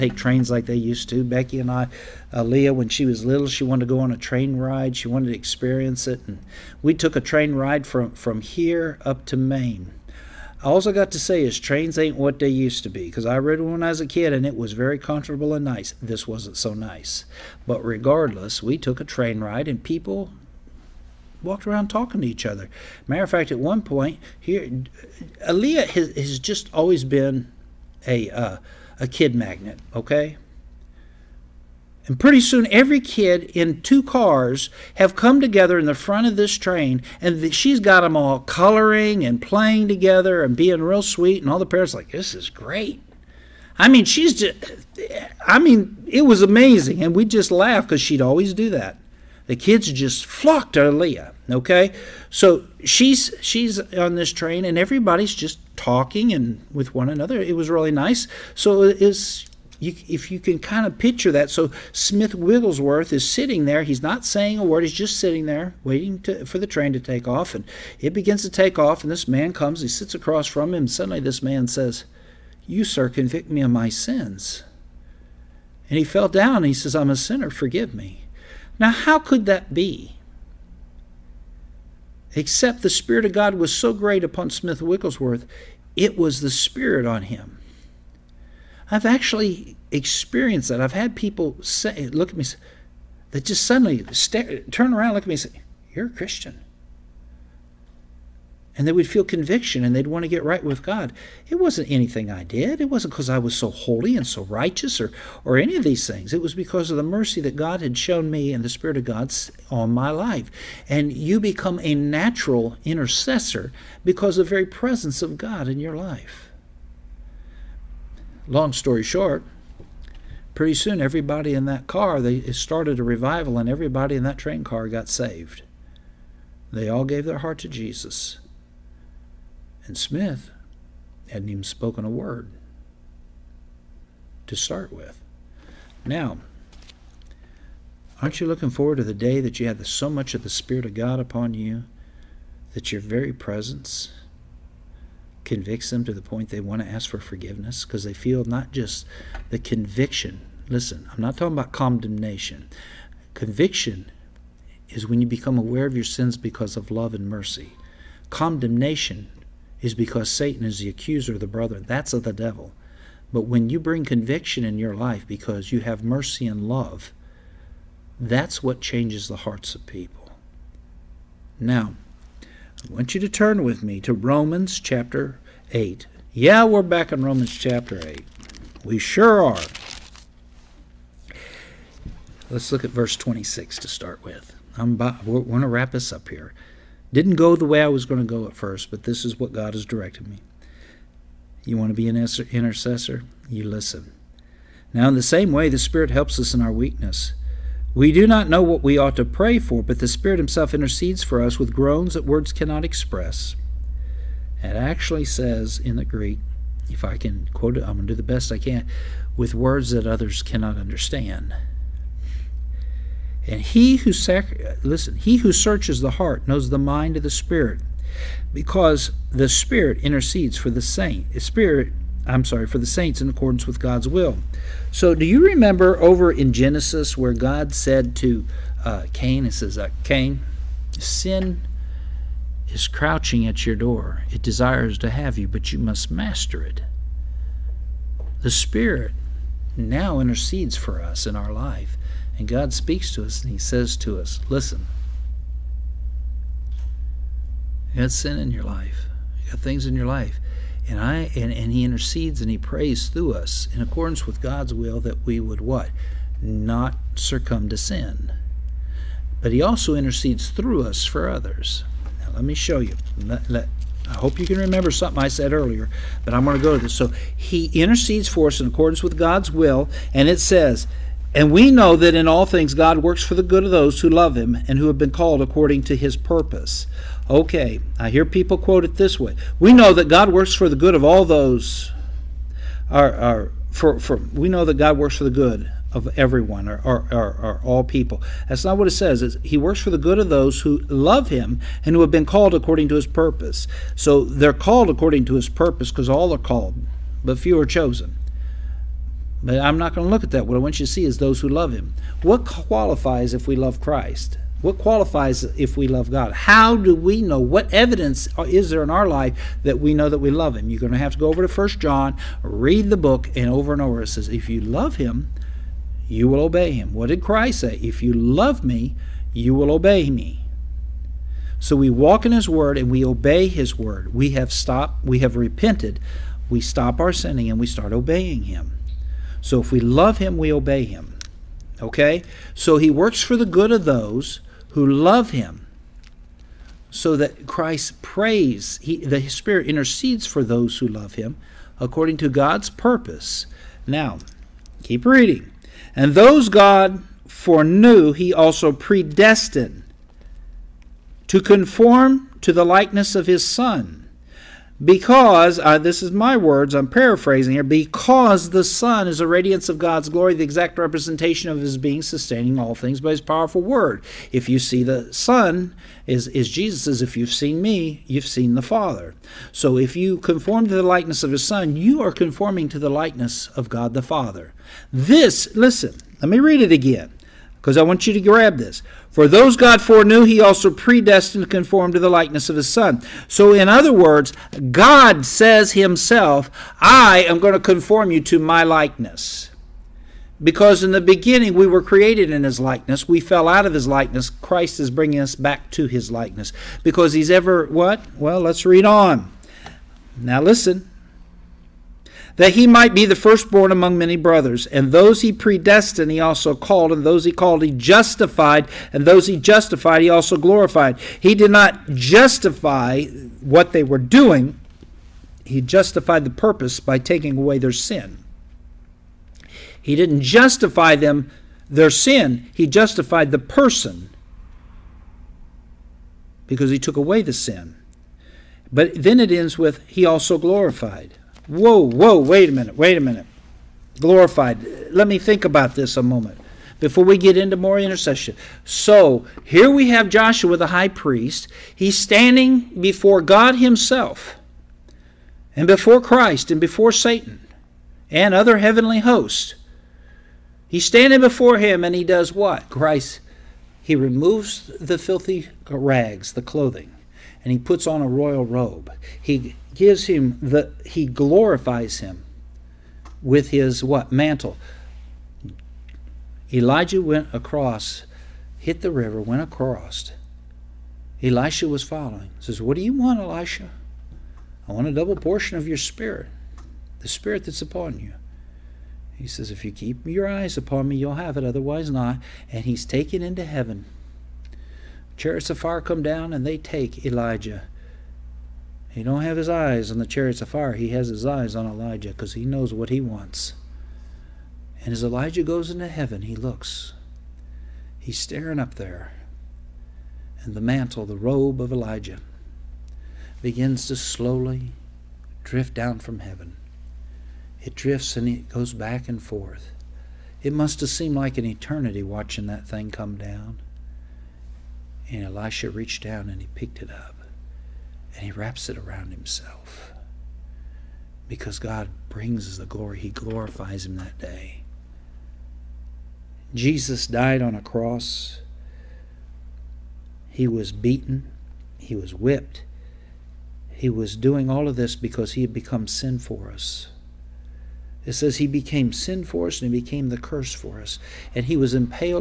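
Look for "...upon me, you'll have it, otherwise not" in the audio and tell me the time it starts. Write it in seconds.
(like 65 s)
480 s.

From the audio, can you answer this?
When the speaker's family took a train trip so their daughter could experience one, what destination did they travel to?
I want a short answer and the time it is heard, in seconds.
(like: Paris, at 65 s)
Maine, at 9 s.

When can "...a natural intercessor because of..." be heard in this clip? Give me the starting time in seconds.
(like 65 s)
111 s.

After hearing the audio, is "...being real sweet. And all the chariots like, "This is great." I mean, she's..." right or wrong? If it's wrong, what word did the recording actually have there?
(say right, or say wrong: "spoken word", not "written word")
wrong: "parents", not "chariots".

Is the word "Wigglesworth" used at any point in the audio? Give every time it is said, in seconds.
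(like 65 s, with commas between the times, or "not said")
62 s, 84 s.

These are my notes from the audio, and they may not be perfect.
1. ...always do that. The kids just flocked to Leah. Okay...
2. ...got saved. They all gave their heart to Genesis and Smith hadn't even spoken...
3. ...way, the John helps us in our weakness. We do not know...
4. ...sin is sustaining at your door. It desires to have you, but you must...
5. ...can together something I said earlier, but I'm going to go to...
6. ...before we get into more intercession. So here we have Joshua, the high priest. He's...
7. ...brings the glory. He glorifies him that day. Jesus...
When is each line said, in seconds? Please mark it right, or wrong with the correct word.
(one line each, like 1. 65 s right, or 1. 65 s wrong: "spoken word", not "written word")
1. 48 s right
2. 124 s wrong: "Jesus", not "Genesis"
3. 195 s wrong: "Spirit", not "John"
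4. 230 s wrong: "crouching", not "sustaining"
5. 264 s wrong: "remember", not "together"
6. 436 s right
7. 522 s right.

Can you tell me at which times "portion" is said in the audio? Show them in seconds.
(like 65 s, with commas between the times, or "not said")
475 s.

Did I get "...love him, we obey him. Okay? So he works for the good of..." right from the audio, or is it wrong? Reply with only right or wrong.
right.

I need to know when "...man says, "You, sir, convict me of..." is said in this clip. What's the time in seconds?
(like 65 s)
71 s.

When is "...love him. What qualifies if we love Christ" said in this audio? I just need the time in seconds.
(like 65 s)
301 s.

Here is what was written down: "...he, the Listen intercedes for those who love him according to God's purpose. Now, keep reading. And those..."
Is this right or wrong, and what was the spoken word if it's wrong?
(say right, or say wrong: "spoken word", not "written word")
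wrong: "Spirit", not "Listen".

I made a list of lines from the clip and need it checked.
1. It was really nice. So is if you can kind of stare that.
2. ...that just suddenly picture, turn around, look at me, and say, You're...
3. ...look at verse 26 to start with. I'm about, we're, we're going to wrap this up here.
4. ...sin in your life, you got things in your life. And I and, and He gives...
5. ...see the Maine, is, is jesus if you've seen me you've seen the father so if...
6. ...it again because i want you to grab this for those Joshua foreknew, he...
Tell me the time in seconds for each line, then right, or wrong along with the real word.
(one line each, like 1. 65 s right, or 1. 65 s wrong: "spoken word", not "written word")
1. 57 s wrong: "picture", not "stare"
2. 93 s wrong: "stare", not "picture"
3. 182 s right
4. 248 s wrong: "intercedes", not "gives"
5. 364 s wrong: "Son", not "Maine"
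6. 376 s wrong: "God", not "Joshua".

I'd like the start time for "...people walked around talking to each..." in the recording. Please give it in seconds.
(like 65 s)
19 s.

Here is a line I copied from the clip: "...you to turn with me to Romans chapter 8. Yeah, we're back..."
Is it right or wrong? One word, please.
right.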